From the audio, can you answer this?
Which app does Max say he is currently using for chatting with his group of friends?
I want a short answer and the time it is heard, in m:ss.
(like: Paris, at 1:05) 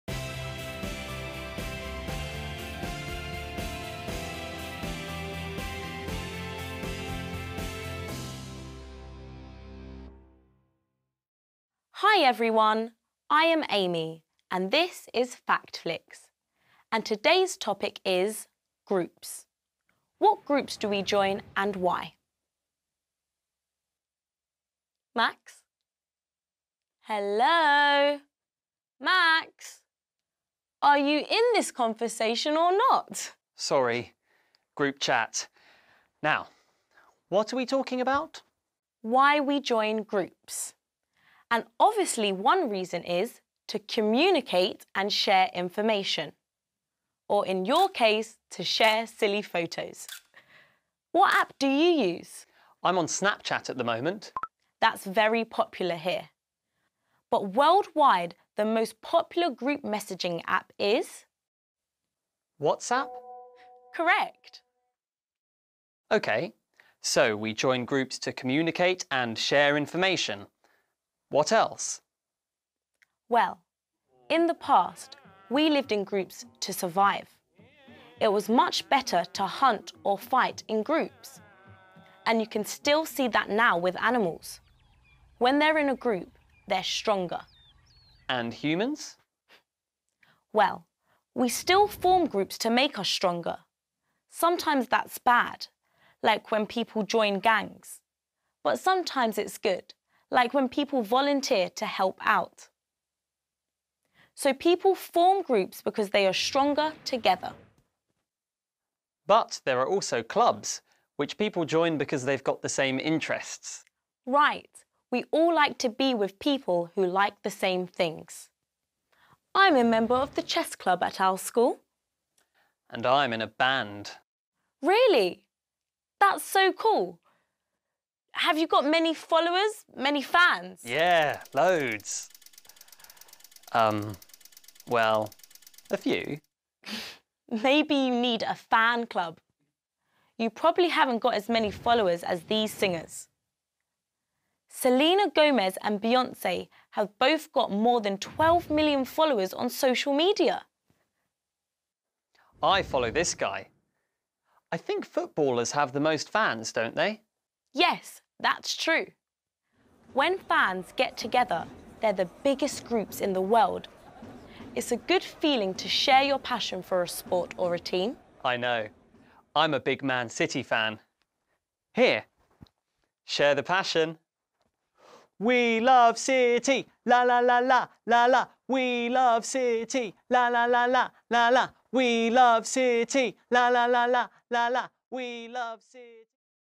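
Snapchat, at 0:53.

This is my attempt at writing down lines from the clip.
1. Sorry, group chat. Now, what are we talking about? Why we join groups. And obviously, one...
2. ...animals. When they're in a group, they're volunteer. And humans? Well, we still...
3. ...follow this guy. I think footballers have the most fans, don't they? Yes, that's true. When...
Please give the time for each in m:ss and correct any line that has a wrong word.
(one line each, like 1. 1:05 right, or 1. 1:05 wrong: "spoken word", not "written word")
1. 0:33 right
2. 1:24 wrong: "stronger", not "volunteer"
3. 2:32 right.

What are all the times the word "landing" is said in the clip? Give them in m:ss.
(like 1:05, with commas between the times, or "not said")
not said.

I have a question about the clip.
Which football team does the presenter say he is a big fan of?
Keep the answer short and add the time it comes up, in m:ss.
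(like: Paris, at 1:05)
Man City, at 2:50.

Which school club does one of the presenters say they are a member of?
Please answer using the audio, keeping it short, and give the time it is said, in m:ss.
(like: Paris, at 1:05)
Chess club, at 2:00.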